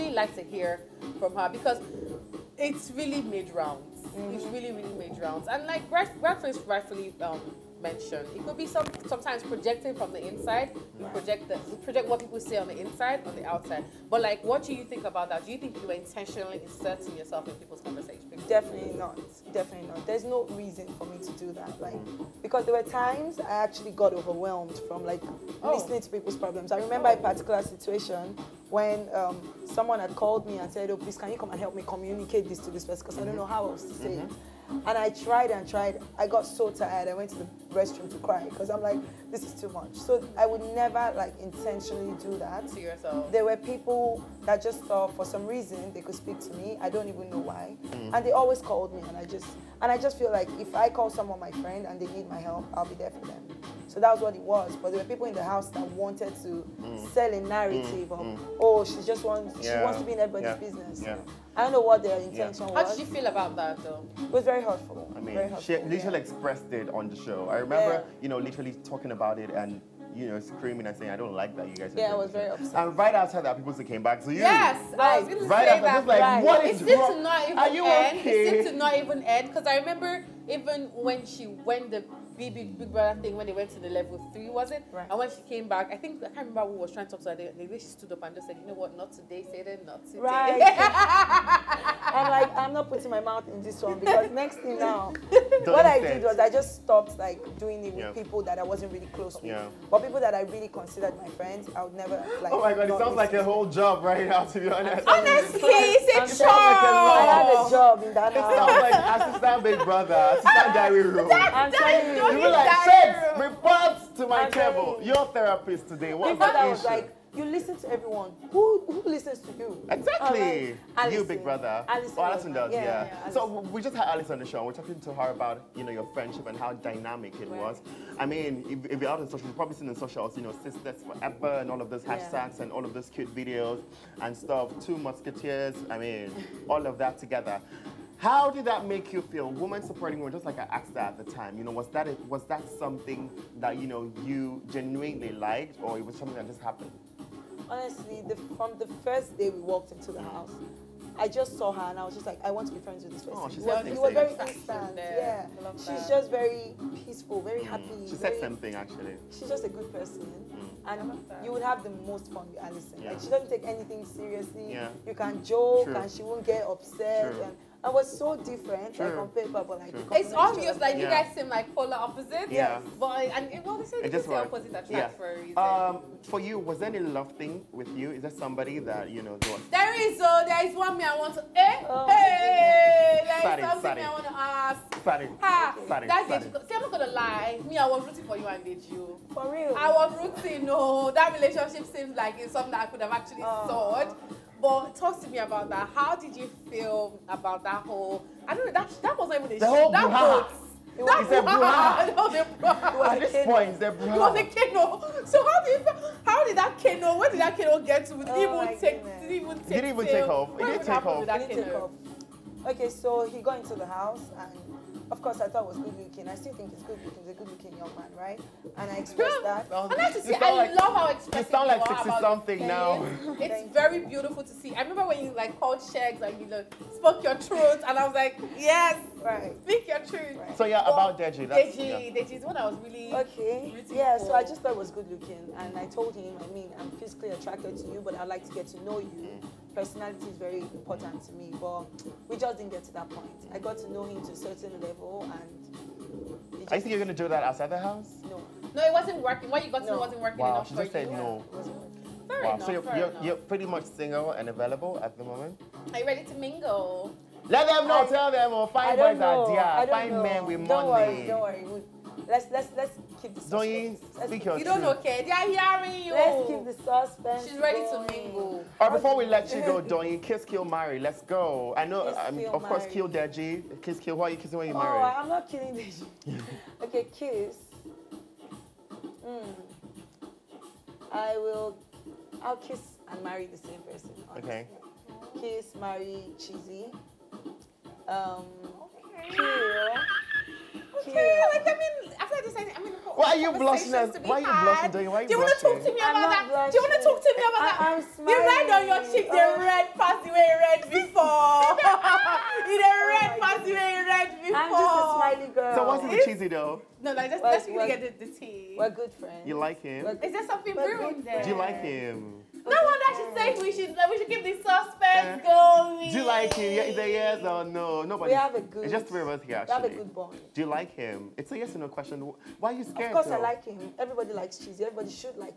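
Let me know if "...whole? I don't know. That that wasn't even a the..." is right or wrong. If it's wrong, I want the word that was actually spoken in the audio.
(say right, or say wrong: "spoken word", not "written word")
right.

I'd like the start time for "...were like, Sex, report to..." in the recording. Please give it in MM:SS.
01:52.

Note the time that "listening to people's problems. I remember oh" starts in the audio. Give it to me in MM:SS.
00:25.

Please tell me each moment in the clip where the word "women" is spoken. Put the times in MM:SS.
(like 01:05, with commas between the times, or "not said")
02:20.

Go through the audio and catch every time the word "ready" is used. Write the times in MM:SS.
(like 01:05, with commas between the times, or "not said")
04:16, 04:27.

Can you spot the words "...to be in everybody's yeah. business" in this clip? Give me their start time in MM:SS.
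00:59.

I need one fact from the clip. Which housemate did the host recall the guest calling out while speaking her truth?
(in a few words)
Sheggz.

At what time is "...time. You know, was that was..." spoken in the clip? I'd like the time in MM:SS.
02:21.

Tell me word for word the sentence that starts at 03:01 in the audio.
Eh, oh, hey, There is sorry, something sorry.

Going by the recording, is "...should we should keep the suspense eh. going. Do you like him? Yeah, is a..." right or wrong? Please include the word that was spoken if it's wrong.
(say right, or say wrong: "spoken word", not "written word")
right.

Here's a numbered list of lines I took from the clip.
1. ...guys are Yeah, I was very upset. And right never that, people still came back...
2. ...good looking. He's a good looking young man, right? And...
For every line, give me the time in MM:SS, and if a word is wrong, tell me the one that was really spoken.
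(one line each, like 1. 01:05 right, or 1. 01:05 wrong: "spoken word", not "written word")
1. 01:11 wrong: "after", not "never"
2. 03:36 right.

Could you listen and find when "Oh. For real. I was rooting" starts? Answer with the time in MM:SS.
03:09.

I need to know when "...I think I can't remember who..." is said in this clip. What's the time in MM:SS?
01:25.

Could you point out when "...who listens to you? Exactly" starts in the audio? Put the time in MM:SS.
01:58.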